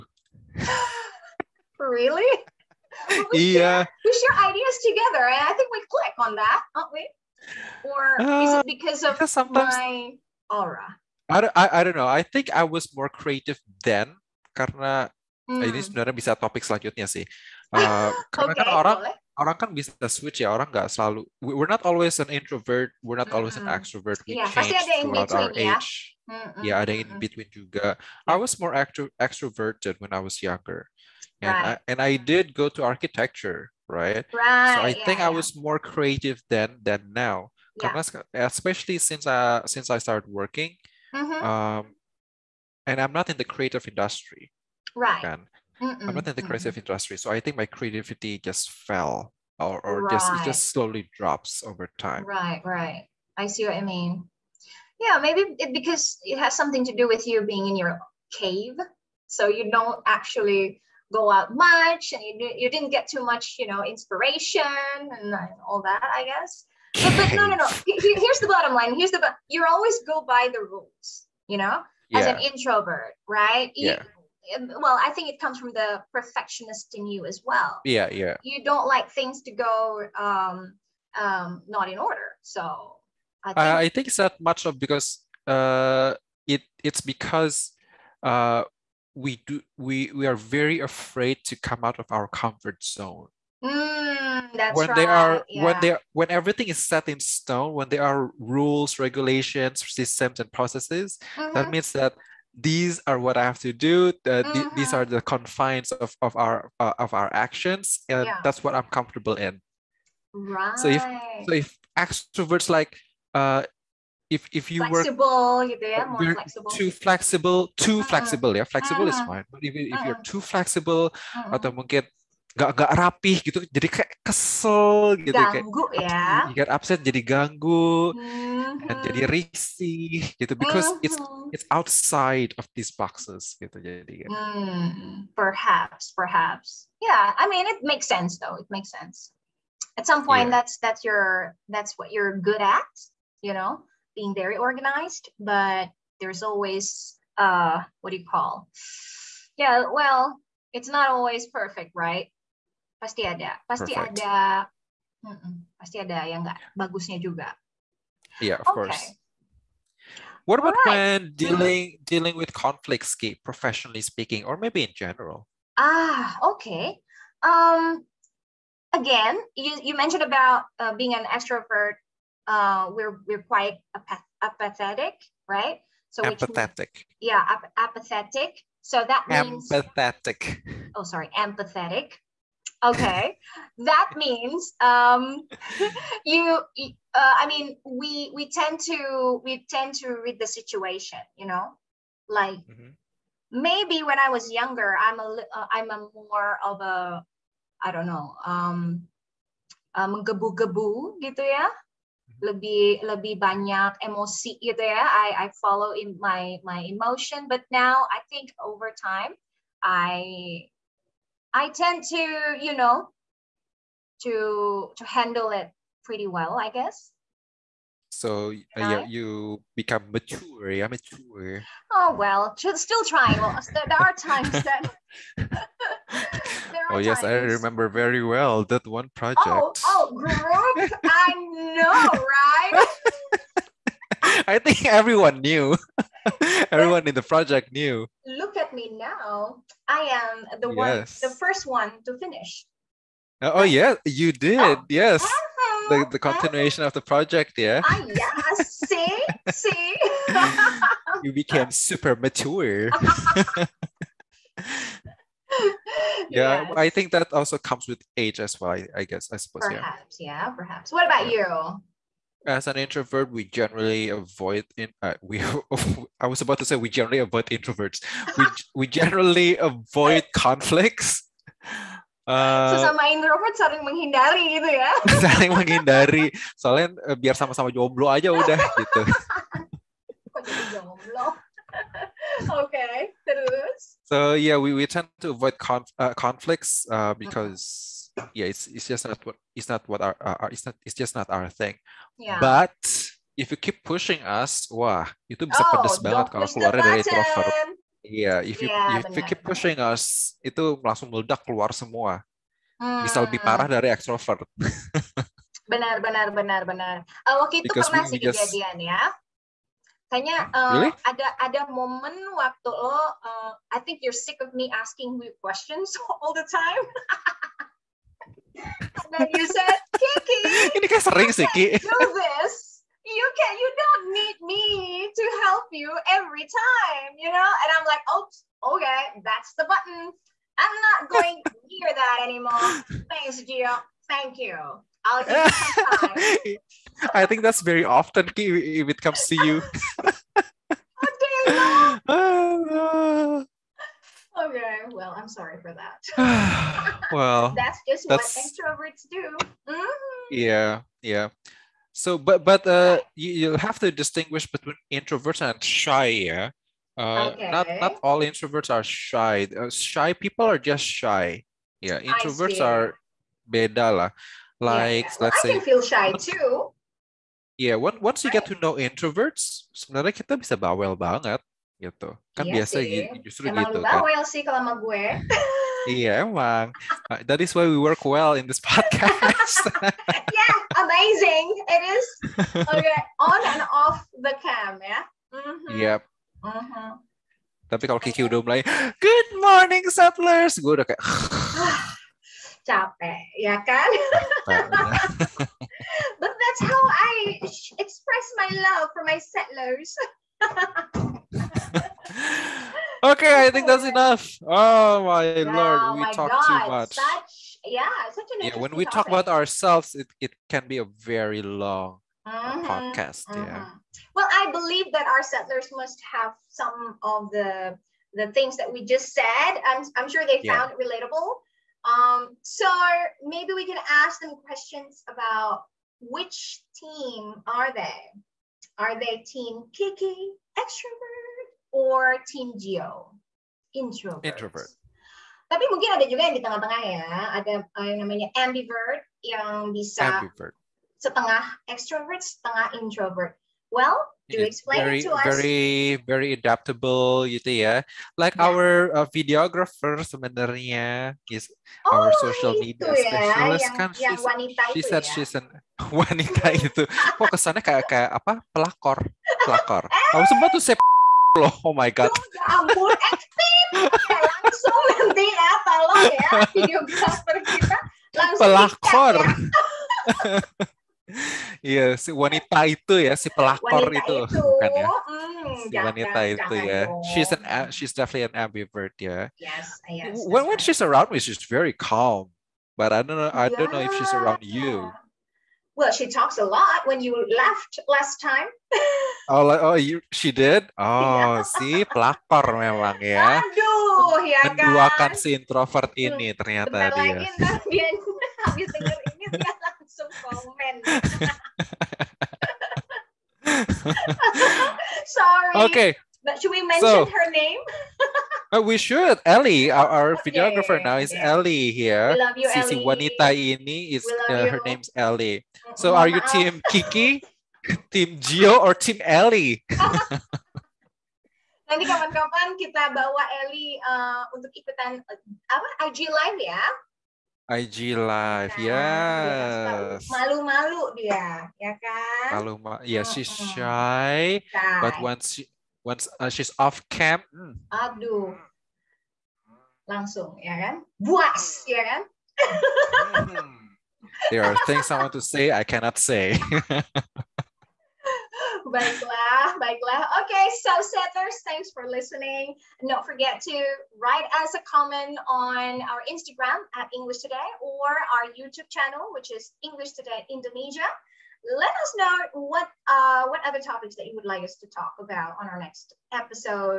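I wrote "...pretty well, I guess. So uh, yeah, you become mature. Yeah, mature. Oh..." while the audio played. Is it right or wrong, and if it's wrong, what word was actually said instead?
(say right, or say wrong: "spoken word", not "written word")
right.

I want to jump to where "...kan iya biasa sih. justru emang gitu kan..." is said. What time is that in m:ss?
6:12.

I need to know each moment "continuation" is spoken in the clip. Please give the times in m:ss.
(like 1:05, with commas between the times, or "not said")
4:06.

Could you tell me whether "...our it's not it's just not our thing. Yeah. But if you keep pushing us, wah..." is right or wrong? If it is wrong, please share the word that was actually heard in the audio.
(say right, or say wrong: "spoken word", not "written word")
right.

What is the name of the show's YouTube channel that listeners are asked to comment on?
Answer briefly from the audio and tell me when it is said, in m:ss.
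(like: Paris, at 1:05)
English Today Indonesia, at 9:19.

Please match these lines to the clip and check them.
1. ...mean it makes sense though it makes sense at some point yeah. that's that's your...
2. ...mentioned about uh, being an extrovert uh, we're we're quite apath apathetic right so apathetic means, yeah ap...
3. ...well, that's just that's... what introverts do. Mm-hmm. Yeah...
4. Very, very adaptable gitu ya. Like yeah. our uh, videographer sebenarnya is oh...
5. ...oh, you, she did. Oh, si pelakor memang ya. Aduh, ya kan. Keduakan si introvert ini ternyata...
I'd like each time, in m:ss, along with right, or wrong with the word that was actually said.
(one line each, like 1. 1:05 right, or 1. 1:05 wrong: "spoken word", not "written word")
1. 2:17 right
2. 2:49 right
3. 5:47 right
4. 7:25 right
5. 8:09 right.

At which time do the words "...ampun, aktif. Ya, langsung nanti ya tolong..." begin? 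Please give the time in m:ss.
7:42.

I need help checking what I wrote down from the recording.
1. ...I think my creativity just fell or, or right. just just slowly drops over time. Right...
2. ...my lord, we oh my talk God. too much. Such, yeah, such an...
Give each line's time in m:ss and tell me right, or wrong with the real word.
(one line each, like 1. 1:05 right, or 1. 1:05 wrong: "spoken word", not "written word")
1. 0:47 right
2. 6:45 right.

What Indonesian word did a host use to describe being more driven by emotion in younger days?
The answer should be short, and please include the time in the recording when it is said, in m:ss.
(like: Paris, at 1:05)
menggebu-gebu, at 3:19.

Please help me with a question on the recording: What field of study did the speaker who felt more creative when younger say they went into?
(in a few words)
architecture.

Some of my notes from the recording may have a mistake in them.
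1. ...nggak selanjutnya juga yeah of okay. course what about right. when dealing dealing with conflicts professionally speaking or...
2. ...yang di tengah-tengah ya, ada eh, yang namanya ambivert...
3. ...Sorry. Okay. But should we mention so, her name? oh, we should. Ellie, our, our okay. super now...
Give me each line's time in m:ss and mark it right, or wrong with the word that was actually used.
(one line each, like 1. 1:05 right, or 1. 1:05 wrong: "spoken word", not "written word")
1. 2:36 wrong: "bagusnya", not "selanjutnya"
2. 7:16 right
3. 8:25 wrong: "videographer", not "super".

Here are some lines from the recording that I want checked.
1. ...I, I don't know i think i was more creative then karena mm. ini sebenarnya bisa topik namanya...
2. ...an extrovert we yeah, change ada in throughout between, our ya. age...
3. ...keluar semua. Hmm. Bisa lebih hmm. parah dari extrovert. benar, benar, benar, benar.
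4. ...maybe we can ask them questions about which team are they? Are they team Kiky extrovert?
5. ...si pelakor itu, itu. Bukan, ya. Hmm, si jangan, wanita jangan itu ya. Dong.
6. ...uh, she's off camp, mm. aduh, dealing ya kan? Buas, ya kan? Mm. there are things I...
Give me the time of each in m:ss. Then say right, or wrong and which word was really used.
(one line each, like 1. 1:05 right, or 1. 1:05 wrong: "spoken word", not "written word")
1. 0:11 wrong: "selanjutnya", not "namanya"
2. 0:23 right
3. 5:01 right
4. 7:03 right
5. 7:53 right
6. 8:56 wrong: "langsung", not "dealing".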